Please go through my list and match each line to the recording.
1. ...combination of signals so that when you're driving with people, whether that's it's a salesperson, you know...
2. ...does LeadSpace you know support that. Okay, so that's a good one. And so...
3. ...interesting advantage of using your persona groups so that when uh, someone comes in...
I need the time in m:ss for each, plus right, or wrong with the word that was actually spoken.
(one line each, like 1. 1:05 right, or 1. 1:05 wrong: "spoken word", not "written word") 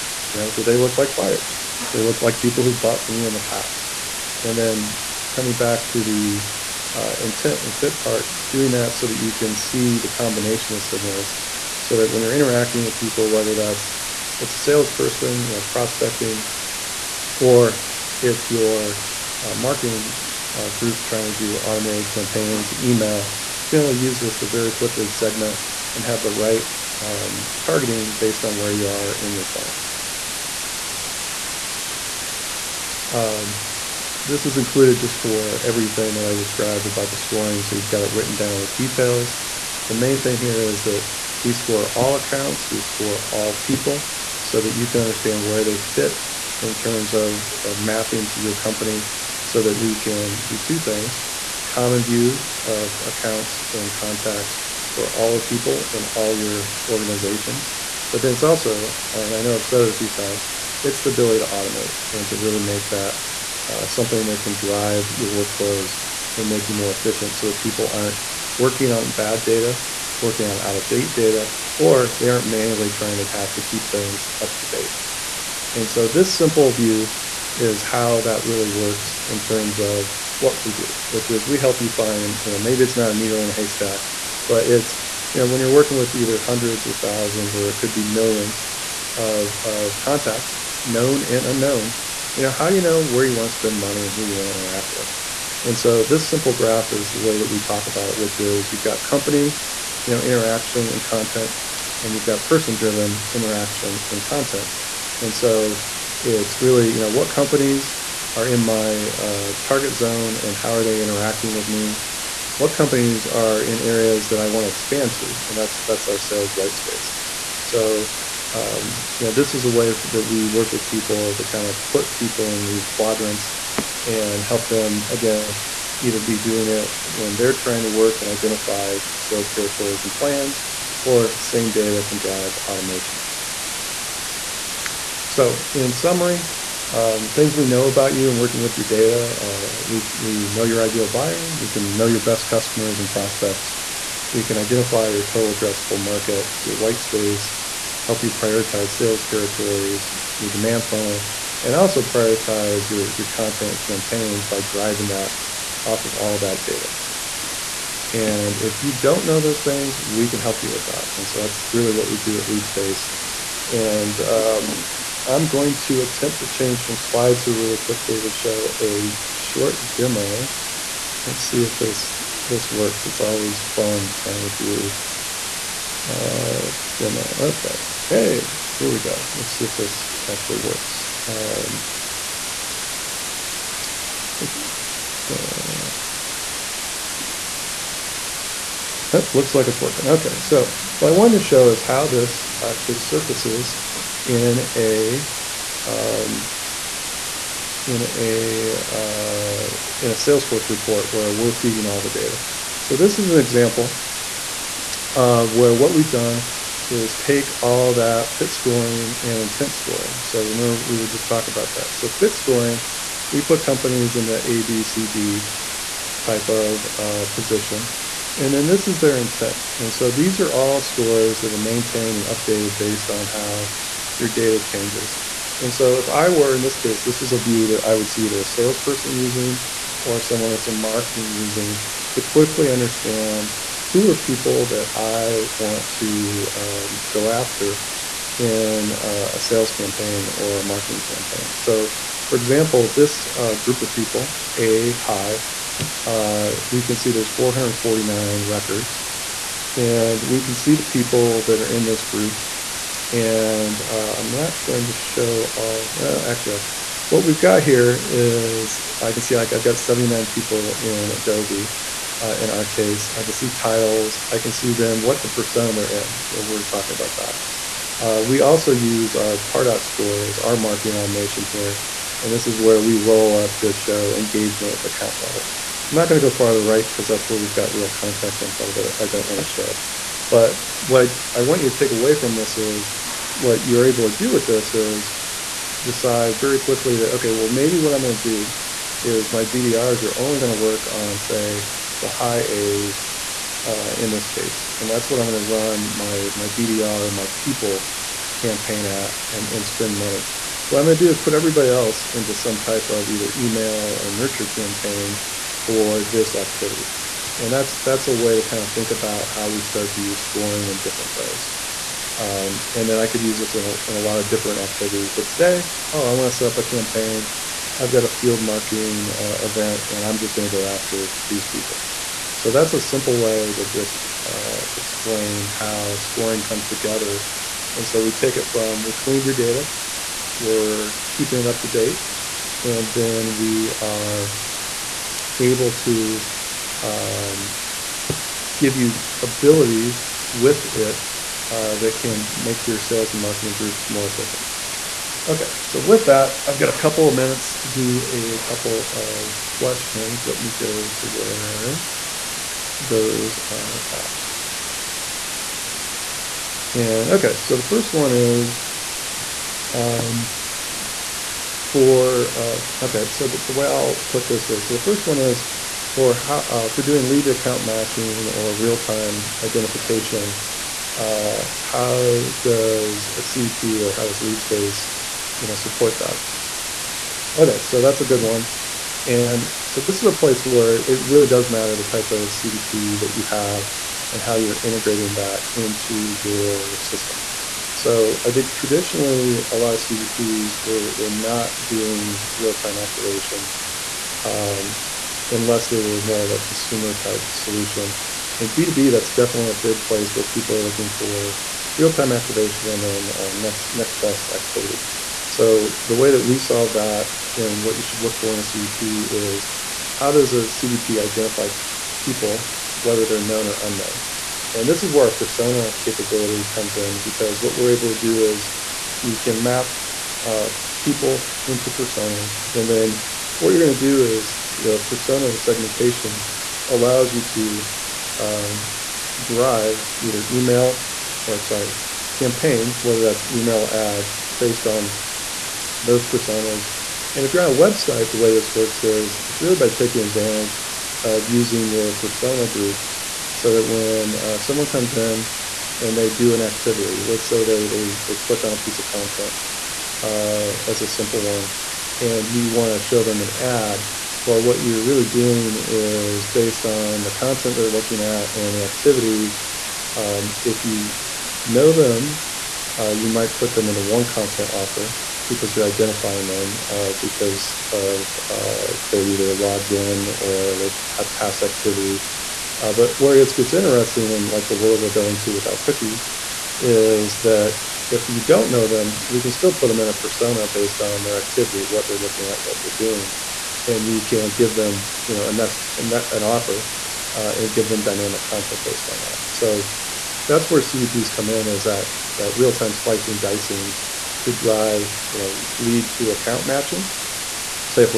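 1. 0:10 wrong: "interacting", not "driving"
2. 6:14 right
3. 7:19 wrong: "taking", not "interesting".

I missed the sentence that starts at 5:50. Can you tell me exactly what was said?
Let me go to where those are at.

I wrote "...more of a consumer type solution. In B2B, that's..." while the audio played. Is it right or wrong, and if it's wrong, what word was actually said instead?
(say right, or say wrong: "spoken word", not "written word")
right.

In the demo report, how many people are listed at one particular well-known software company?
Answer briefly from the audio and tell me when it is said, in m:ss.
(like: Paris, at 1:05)
79, at 4:19.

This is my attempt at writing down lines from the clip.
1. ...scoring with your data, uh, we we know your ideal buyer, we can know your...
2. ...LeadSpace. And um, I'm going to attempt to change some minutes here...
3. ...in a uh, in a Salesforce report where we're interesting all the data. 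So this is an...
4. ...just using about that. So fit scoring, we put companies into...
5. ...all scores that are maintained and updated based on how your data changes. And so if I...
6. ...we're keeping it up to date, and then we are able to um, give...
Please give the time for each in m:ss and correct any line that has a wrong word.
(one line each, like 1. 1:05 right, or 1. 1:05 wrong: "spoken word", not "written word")
1. 2:18 wrong: "working", not "scoring"
2. 2:42 wrong: "slides", not "minutes"
3. 3:17 wrong: "feeding", not "interesting"
4. 3:31 wrong: "talking", not "using"
5. 3:40 right
6. 5:30 right.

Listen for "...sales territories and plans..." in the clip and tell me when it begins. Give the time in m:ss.
2:09.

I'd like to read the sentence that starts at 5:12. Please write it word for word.
Um, and then I could use this in a, in a lot of different activities.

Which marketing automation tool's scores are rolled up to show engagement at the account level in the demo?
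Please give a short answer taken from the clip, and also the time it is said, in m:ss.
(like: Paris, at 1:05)
Pardot, at 4:29.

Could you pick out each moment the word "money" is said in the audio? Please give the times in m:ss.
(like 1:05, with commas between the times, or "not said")
1:33, 4:59.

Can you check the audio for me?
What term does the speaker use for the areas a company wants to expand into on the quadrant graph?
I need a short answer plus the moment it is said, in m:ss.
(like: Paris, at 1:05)
sales white space, at 1:56.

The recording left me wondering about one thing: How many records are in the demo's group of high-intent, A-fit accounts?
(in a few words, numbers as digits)
449.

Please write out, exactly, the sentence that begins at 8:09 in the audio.
So that's where CDPs come in, is that that real time slicing, dicing, to drive, you know, lead to account matching.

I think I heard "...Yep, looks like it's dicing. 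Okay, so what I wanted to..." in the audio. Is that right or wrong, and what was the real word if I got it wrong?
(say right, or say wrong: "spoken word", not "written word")
wrong: "working", not "dicing".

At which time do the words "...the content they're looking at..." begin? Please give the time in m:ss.
7:37.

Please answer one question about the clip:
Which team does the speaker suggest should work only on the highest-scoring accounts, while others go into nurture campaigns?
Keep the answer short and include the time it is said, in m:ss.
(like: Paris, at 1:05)
BDRs, at 4:49.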